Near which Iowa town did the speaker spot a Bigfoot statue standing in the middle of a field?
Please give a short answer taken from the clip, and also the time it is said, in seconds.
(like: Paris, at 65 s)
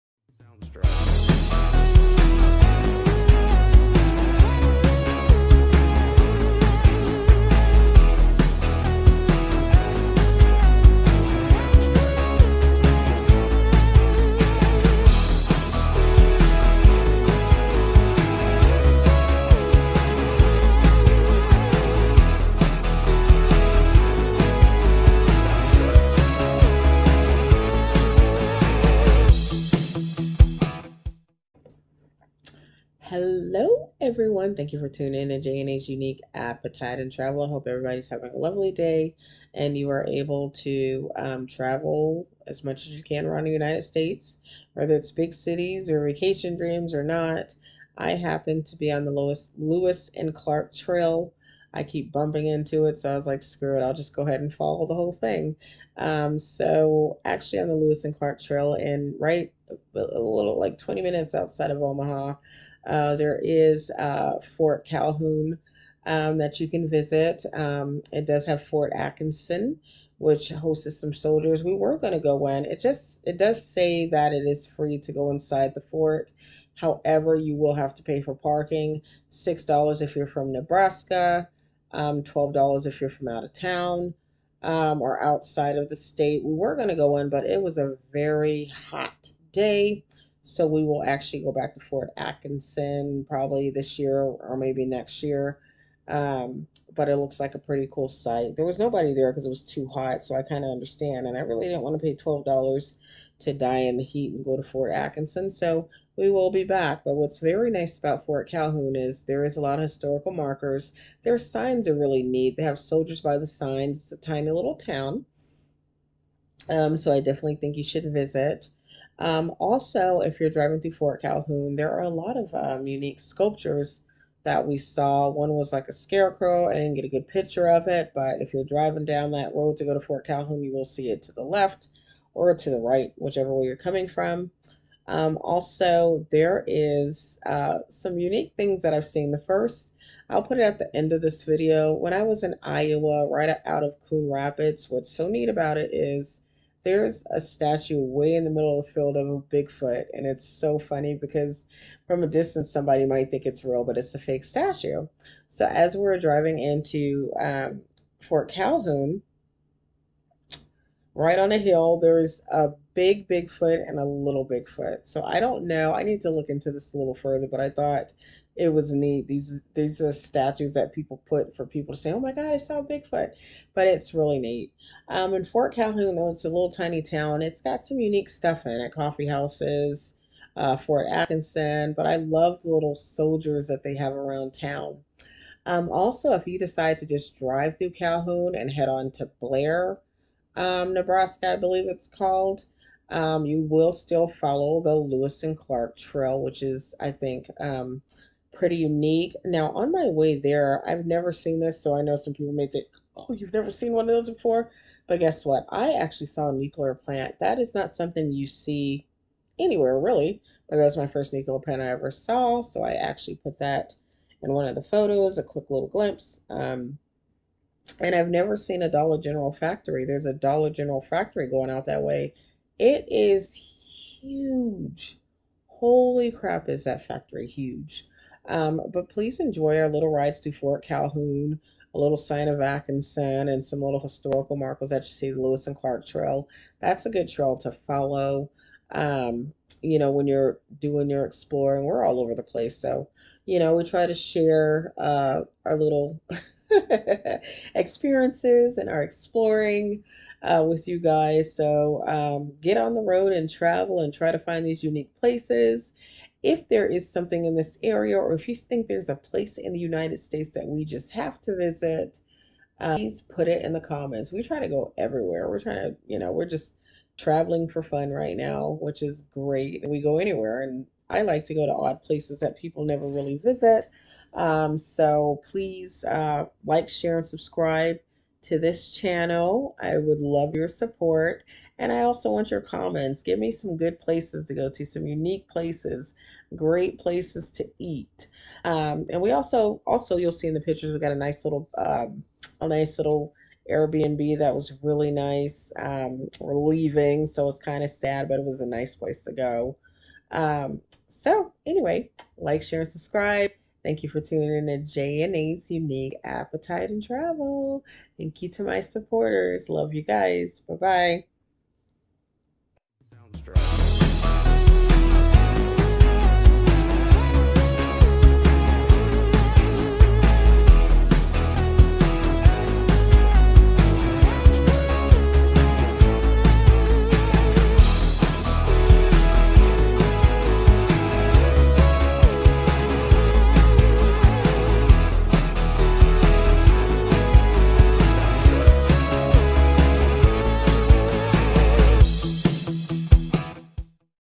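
Coon Rapids, at 144 s.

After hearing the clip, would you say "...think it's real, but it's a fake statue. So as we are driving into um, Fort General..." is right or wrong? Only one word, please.
wrong.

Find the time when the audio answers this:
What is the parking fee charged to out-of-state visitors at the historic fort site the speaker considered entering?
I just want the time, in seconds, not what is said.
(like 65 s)
82 s.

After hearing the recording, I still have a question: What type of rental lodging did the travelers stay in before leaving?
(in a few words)
Airbnb.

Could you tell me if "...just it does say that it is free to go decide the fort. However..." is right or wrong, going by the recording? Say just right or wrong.
wrong.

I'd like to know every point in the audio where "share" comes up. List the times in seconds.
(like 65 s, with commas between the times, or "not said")
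244 s, 276 s, 302 s.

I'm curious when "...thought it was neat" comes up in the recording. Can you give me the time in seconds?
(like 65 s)
167 s.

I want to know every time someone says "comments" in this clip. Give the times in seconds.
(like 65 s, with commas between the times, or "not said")
263 s, 282 s.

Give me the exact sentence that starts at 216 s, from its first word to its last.
Um, and I've never seen a Dollar General factory.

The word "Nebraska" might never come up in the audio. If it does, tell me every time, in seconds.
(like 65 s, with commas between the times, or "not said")
80 s, 190 s.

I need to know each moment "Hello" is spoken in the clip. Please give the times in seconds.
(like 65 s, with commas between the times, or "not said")
33 s.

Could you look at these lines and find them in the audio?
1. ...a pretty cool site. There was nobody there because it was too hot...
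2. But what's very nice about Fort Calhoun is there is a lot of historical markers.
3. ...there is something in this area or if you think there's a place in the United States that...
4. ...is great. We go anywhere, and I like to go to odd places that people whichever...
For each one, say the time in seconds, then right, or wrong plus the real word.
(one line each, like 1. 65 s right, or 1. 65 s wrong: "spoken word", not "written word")
1. 97 s right
2. 107 s right
3. 256 s right
4. 269 s wrong: "never", not "whichever".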